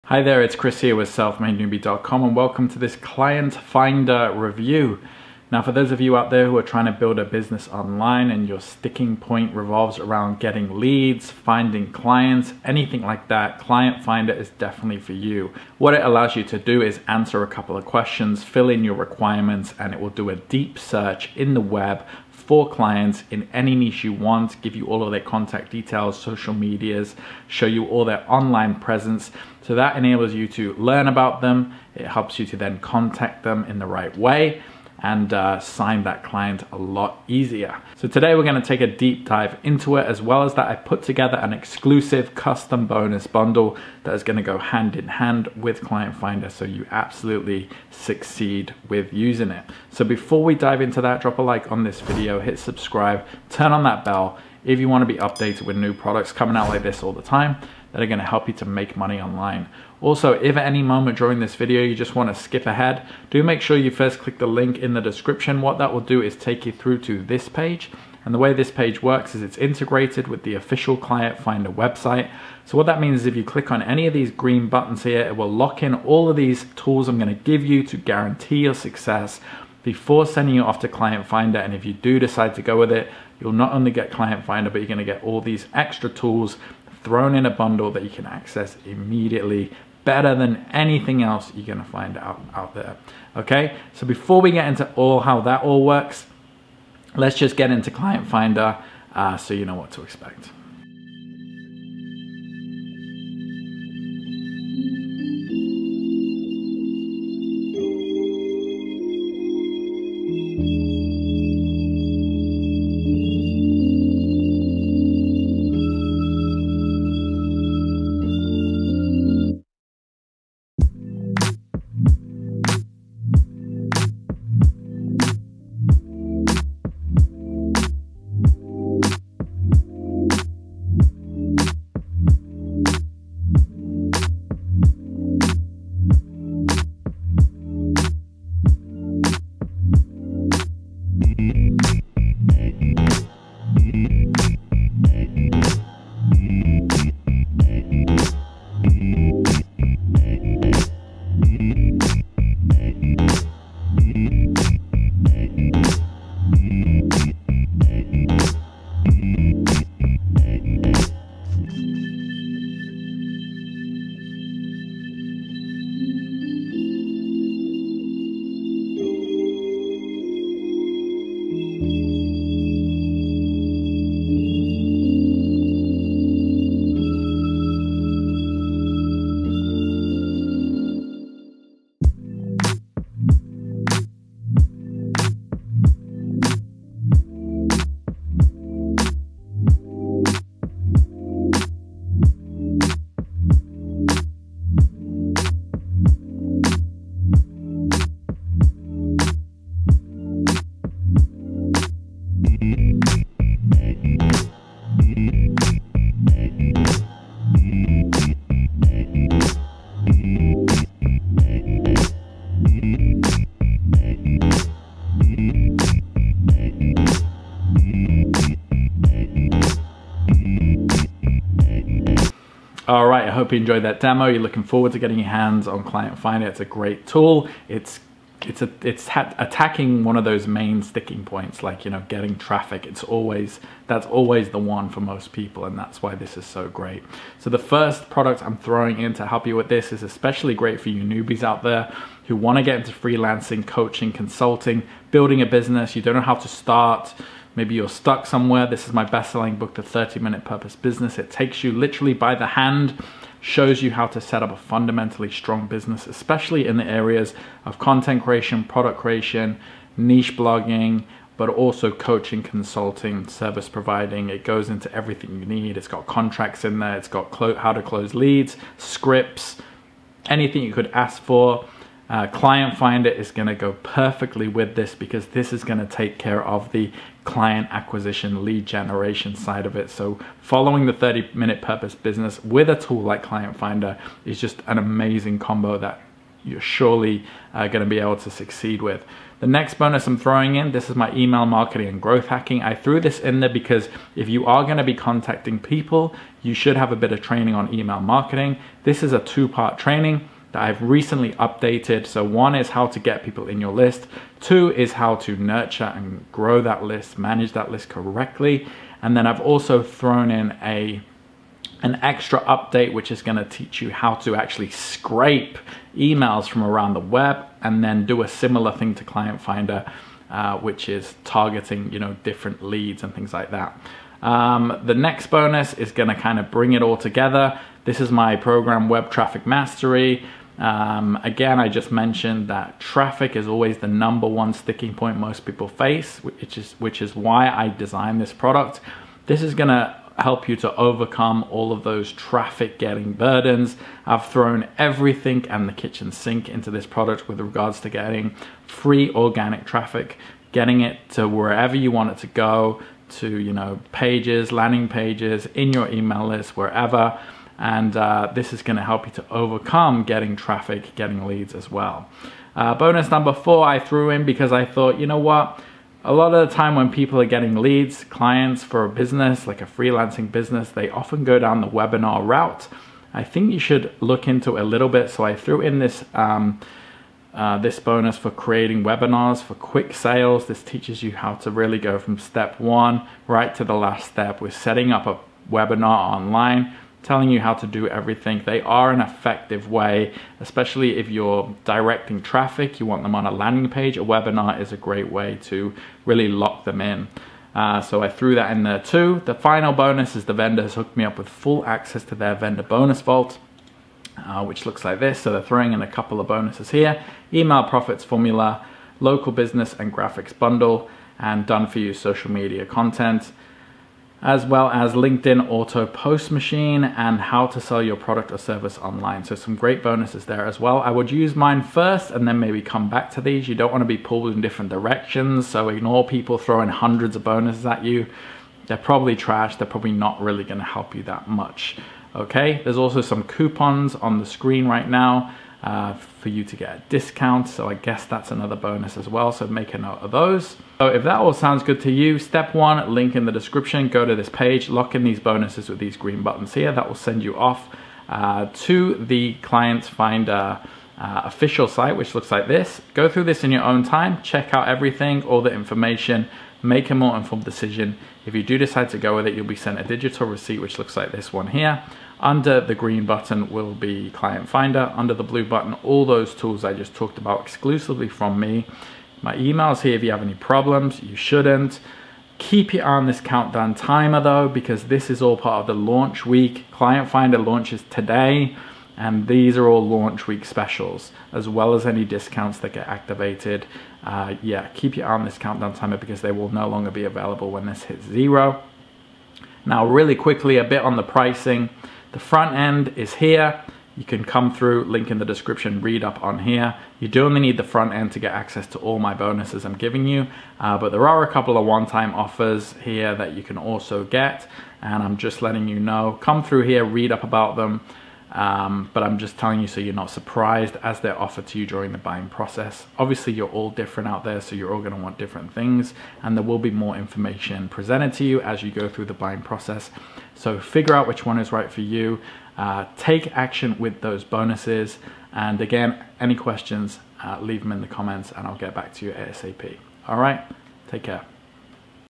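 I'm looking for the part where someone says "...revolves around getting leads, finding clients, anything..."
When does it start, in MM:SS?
00:09.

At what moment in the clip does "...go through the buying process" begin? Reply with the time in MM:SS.
08:38.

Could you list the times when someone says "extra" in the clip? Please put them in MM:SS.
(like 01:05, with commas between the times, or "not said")
01:25, 05:12.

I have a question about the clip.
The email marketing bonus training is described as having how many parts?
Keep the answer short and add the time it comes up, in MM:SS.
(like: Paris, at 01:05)
2, at 04:59.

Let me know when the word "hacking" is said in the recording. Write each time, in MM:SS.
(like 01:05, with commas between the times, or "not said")
04:52.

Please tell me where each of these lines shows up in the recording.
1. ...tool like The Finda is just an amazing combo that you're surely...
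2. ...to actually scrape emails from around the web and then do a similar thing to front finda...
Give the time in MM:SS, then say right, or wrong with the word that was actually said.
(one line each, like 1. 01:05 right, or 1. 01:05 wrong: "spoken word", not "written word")
1. 04:42 wrong: "Client", not "The"
2. 05:14 wrong: "client", not "front".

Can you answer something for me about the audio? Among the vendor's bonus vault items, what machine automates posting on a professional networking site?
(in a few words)
LinkedIn Auto Post Machine.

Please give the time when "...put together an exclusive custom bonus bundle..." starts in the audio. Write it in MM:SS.
00:40.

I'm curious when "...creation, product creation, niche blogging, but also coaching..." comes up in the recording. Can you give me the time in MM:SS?
04:18.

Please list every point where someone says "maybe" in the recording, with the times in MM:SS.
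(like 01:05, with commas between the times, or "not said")
04:07, 07:02.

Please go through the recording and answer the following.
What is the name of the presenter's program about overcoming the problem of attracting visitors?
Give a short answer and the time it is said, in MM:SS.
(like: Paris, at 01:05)
Web Traffic Mastery, at 05:28.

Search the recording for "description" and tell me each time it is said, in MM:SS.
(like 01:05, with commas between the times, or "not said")
01:05, 07:23, 08:15.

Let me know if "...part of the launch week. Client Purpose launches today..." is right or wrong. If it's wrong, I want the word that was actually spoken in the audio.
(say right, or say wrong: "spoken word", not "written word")
wrong: "Finda", not "Purpose".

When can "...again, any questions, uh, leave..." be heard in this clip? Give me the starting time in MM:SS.
08:45.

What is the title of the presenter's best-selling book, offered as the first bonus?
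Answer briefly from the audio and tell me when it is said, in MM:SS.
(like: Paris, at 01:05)
The 30-Minute Purpose Business, at 04:09.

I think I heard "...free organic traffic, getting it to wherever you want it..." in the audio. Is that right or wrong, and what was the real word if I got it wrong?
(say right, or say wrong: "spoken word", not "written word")
right.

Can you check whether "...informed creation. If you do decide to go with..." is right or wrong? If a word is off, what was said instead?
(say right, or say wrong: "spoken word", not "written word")
wrong: "decision", not "creation".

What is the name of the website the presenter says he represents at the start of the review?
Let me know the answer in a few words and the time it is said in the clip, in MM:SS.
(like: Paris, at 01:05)
selfmadenewbie.com, at 00:01.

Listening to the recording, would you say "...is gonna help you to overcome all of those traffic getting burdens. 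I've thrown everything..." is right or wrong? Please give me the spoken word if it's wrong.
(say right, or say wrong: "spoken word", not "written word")
right.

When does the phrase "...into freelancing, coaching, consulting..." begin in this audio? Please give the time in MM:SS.
04:02.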